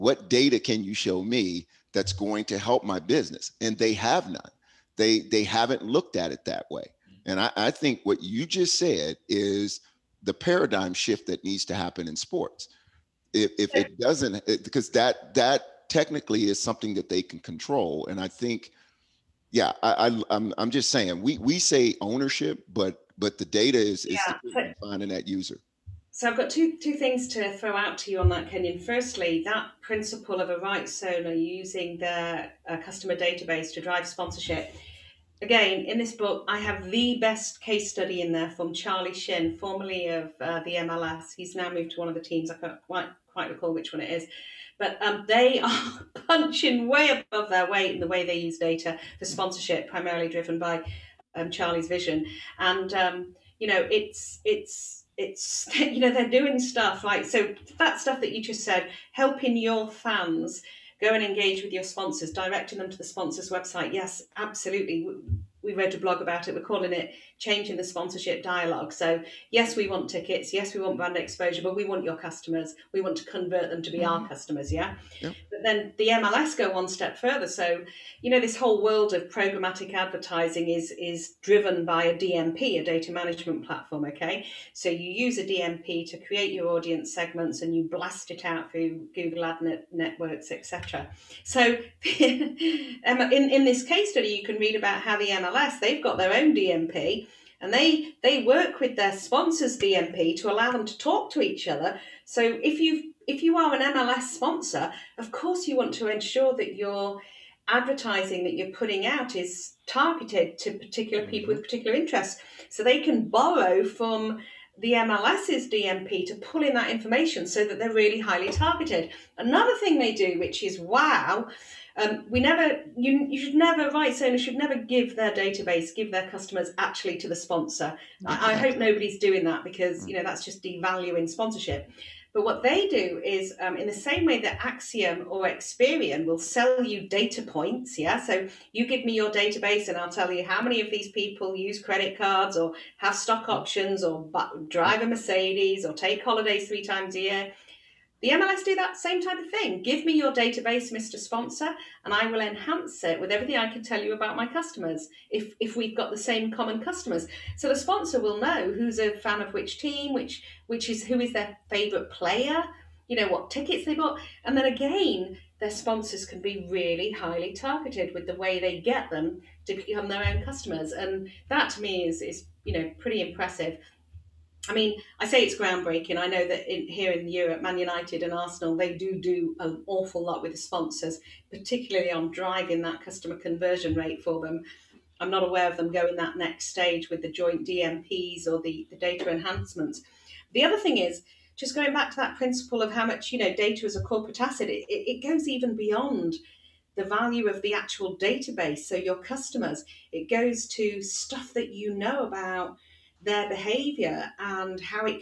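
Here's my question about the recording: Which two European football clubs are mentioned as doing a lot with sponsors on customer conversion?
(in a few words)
Man United and Arsenal.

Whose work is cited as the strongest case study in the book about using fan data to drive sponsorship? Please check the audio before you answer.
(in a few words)
Charlie Shin.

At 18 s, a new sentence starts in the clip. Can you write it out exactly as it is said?
And I think, yeah, I, am I'm, I'm just saying we we say ownership, but but the data is, is yeah.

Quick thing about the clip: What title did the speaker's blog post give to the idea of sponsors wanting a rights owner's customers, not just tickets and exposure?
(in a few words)
Changing the Sponsorship Dialogue.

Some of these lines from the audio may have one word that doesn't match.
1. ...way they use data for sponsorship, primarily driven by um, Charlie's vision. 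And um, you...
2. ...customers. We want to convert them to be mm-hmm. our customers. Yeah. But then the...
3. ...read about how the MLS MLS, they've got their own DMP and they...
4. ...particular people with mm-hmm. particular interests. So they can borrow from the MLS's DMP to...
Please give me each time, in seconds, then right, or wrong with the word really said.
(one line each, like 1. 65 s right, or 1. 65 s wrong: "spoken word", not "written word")
1. 48 s right
2. 72 s right
3. 94 s right
4. 110 s right.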